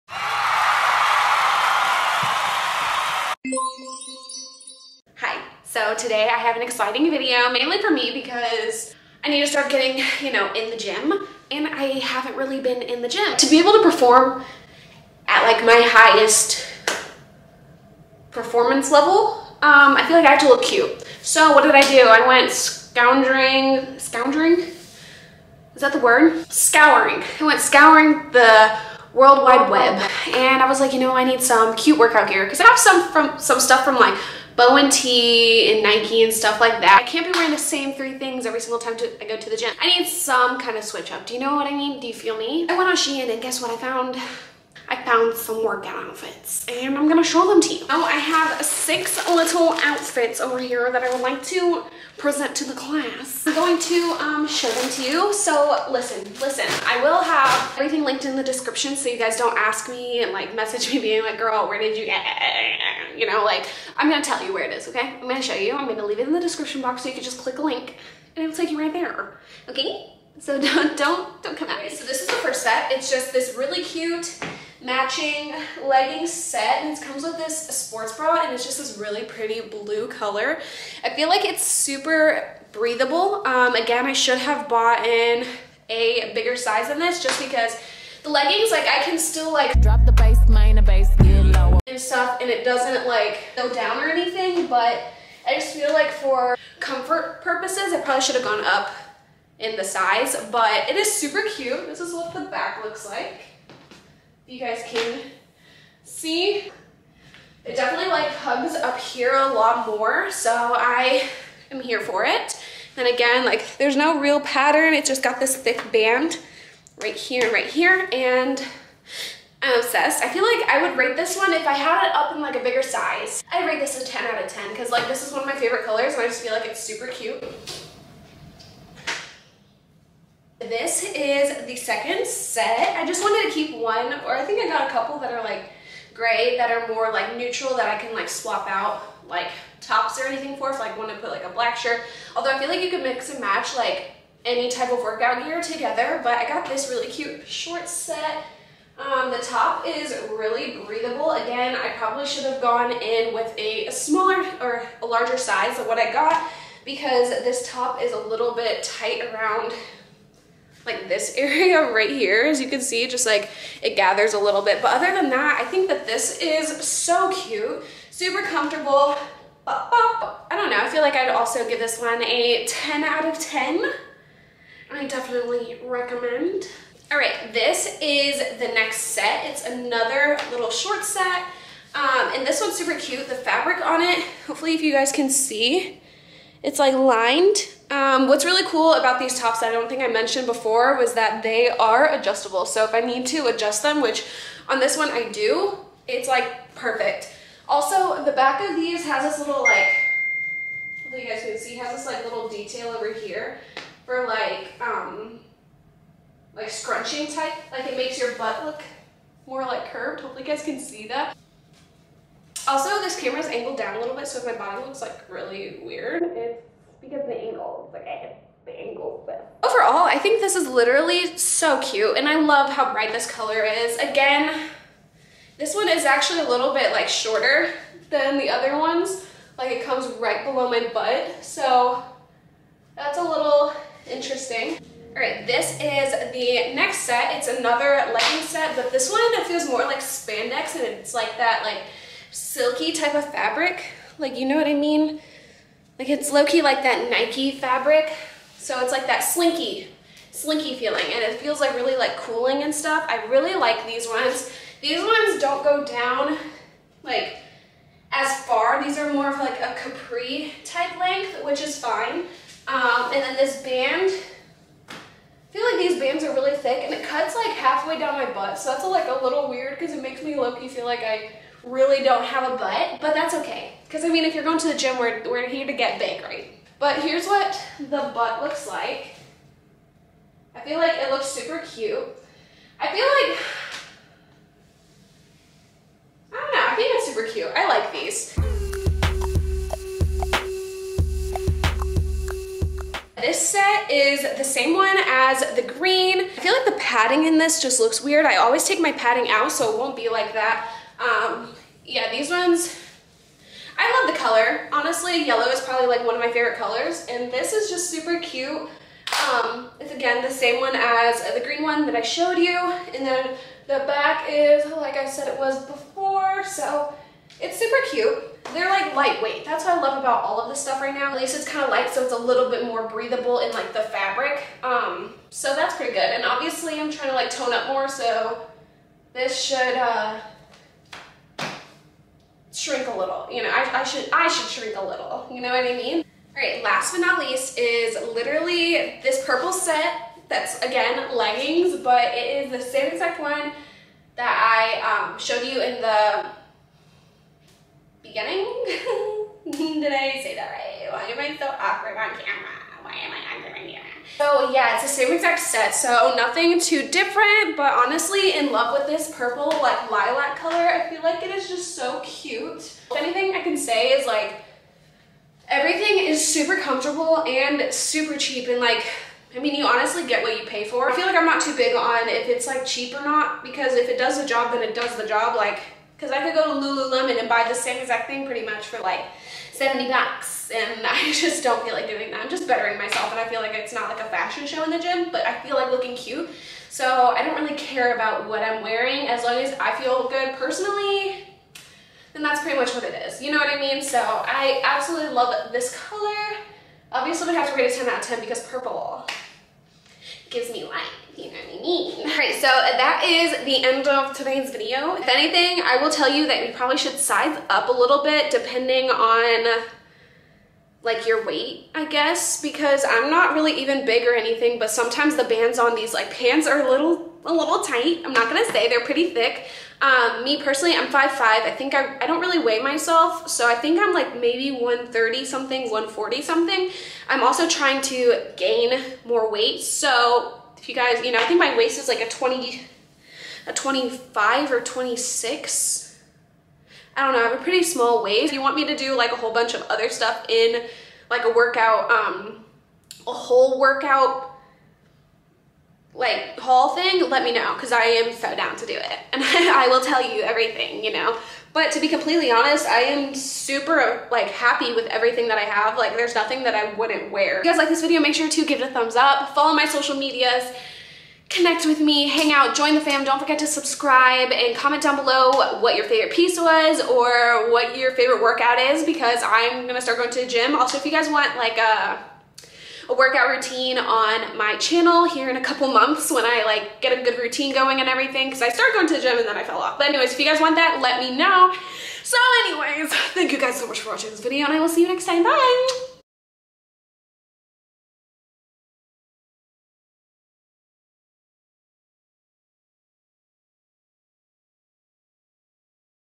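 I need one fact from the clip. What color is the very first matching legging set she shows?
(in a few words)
blue.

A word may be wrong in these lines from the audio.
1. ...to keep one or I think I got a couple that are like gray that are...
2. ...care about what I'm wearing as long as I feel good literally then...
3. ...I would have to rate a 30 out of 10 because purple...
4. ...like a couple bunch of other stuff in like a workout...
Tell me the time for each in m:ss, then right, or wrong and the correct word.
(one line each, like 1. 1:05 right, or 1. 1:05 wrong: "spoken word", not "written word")
1. 2:13 right
2. 6:27 wrong: "personally", not "literally"
3. 6:37 wrong: "10", not "30"
4. 7:18 wrong: "whole", not "couple".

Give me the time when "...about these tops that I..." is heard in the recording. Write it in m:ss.
3:08.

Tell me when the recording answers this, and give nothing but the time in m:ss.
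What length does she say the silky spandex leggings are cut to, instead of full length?
4:19.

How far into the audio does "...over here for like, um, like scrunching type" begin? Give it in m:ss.
3:22.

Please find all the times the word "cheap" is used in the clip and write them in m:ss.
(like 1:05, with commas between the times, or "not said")
6:08, 6:12.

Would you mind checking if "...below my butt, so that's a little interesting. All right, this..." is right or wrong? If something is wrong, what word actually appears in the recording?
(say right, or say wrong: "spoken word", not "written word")
right.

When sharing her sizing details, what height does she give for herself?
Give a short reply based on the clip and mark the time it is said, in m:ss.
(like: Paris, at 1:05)
5'5", at 7:00.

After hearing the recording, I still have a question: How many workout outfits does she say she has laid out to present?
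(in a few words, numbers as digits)
6.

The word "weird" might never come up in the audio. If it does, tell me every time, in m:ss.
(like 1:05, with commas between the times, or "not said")
3:35, 4:29, 4:58.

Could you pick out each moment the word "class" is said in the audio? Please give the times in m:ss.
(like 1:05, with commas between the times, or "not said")
0:52.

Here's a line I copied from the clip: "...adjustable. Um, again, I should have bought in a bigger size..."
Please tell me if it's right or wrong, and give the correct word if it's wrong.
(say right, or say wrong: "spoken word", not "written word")
wrong: "breathable", not "adjustable".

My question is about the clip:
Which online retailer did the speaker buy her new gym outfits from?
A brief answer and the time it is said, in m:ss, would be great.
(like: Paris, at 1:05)
Shein, at 0:42.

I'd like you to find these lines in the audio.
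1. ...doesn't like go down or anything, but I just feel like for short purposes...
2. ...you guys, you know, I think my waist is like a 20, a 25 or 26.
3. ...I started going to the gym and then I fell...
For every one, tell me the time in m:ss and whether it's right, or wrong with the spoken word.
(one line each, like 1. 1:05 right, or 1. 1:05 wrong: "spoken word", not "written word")
1. 1:32 wrong: "comfort", not "short"
2. 7:10 right
3. 7:58 right.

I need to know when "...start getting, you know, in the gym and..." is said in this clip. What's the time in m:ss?
0:09.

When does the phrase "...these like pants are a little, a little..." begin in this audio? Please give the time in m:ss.
6:55.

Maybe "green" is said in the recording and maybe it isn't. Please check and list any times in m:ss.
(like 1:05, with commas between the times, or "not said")
4:55, 5:11.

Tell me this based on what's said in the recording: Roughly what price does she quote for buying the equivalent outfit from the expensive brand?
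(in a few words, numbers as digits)
70 bucks.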